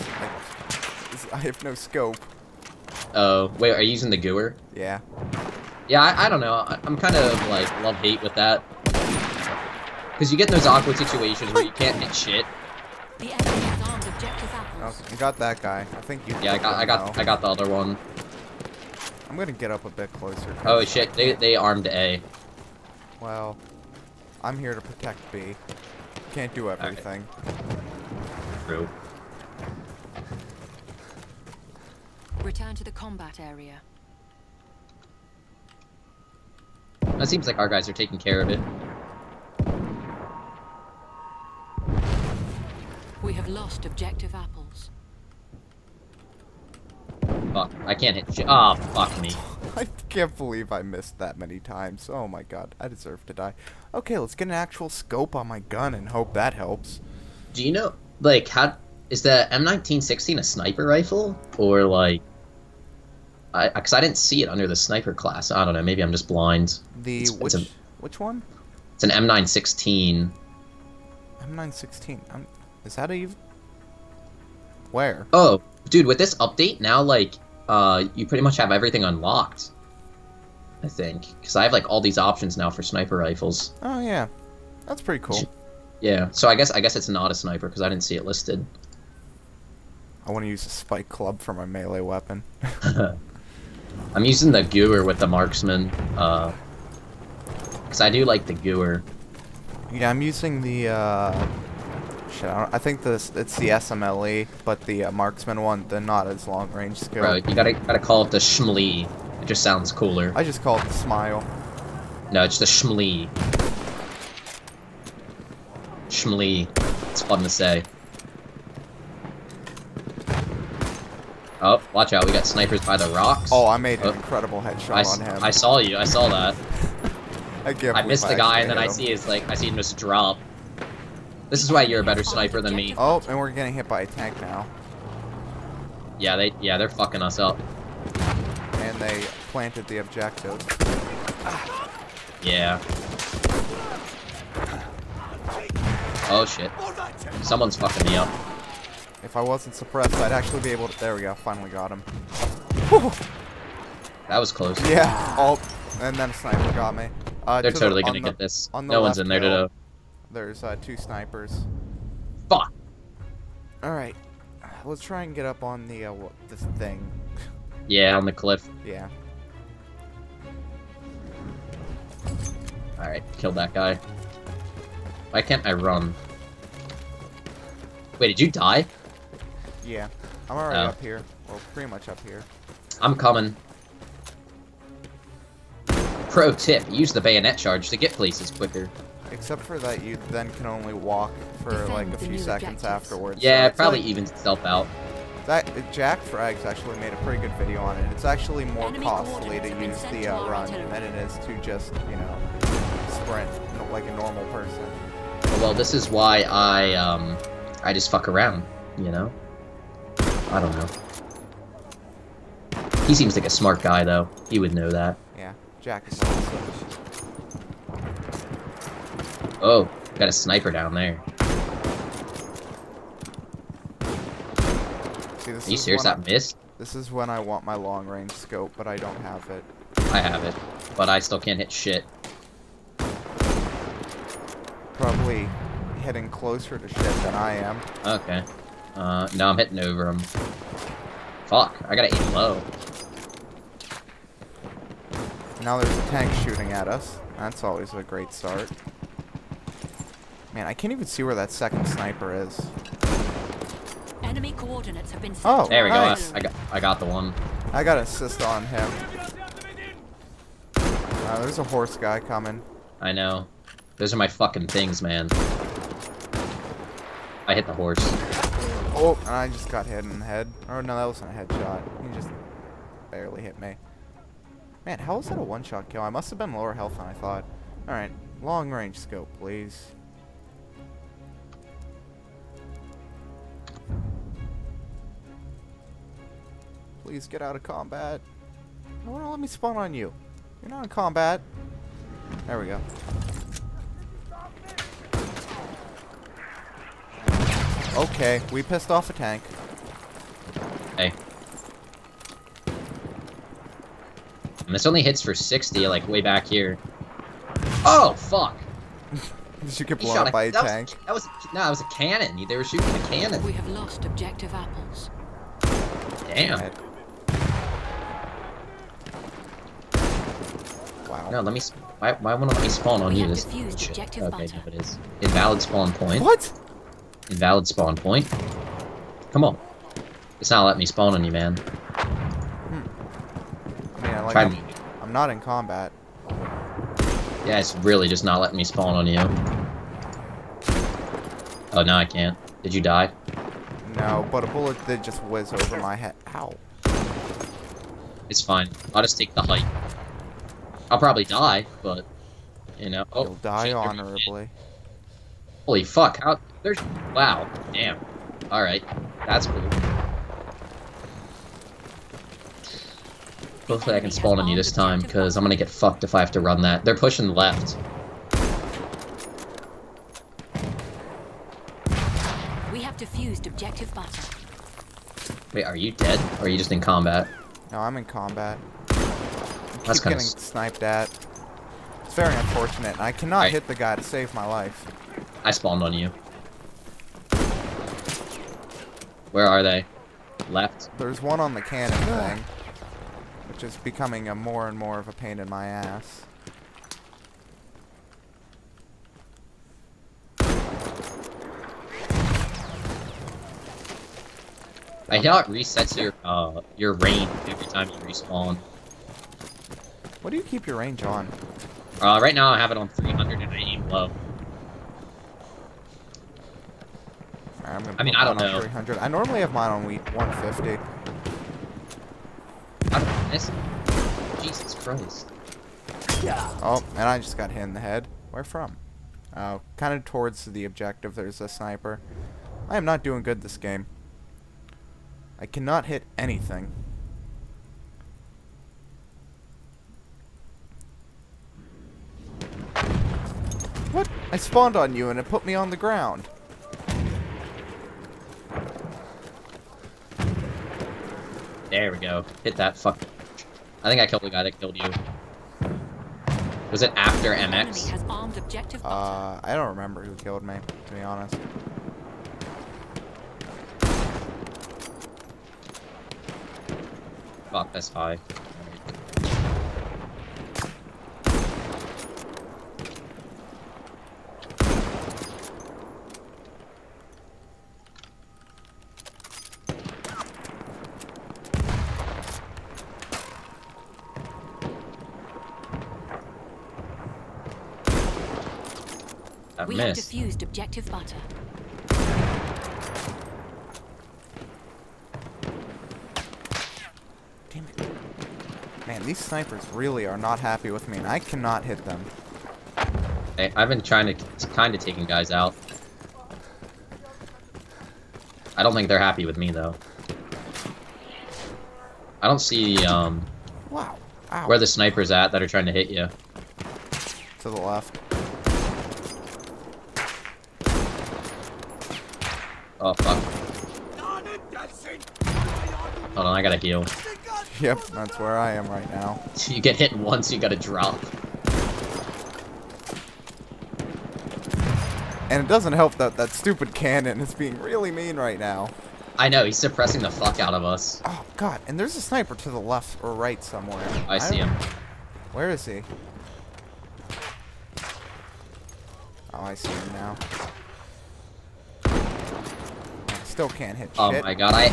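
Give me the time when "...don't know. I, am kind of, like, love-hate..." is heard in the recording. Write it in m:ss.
0:06.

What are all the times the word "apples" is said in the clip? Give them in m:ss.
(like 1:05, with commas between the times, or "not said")
0:14, 0:44, 5:14.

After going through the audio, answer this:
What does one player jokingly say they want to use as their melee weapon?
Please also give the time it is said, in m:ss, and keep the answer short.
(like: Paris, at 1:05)
spike club, at 1:30.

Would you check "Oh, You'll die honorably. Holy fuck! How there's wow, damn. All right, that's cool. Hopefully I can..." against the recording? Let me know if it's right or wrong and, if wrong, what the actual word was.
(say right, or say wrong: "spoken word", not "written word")
right.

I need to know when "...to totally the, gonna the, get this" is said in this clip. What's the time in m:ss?
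2:37.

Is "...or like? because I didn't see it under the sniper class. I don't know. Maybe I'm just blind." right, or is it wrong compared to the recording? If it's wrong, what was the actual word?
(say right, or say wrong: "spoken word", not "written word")
right.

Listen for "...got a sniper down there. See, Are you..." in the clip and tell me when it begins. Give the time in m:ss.
3:40.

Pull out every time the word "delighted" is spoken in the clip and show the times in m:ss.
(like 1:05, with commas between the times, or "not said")
not said.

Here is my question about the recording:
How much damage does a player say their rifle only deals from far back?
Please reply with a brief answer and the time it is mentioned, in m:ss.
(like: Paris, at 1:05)
60, at 5:05.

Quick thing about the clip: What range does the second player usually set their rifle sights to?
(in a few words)
150.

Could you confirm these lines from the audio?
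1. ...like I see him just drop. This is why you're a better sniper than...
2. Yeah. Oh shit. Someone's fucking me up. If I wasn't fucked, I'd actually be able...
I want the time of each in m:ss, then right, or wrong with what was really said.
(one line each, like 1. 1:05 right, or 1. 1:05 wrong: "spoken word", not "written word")
1. 2:09 right
2. 2:22 wrong: "suppressed", not "fucked".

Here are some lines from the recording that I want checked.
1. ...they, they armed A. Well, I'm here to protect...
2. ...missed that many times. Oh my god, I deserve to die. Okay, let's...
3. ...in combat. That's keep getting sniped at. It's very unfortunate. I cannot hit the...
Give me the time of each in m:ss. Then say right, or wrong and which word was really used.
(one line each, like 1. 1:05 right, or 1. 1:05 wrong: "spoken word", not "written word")
1. 0:21 right
2. 0:50 right
3. 6:17 right.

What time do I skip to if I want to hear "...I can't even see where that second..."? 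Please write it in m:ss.
4:10.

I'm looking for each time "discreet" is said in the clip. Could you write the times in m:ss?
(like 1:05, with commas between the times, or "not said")
not said.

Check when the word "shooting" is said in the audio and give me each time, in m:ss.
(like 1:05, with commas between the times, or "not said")
4:06, 5:12.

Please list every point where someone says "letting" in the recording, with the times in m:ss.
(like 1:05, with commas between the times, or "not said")
5:30, 5:38.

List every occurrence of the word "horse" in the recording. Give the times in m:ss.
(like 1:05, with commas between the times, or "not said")
4:21, 4:27.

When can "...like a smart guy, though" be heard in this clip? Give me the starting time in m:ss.
3:33.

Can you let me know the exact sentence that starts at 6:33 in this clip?
Which is becoming a more and more of a pain in my ass.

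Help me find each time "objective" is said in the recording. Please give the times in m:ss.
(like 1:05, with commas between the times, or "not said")
0:14, 0:43, 2:19, 3:12, 5:14, 6:13, 7:10, 8:10.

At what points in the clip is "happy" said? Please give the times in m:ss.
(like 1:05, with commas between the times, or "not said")
8:20, 8:28.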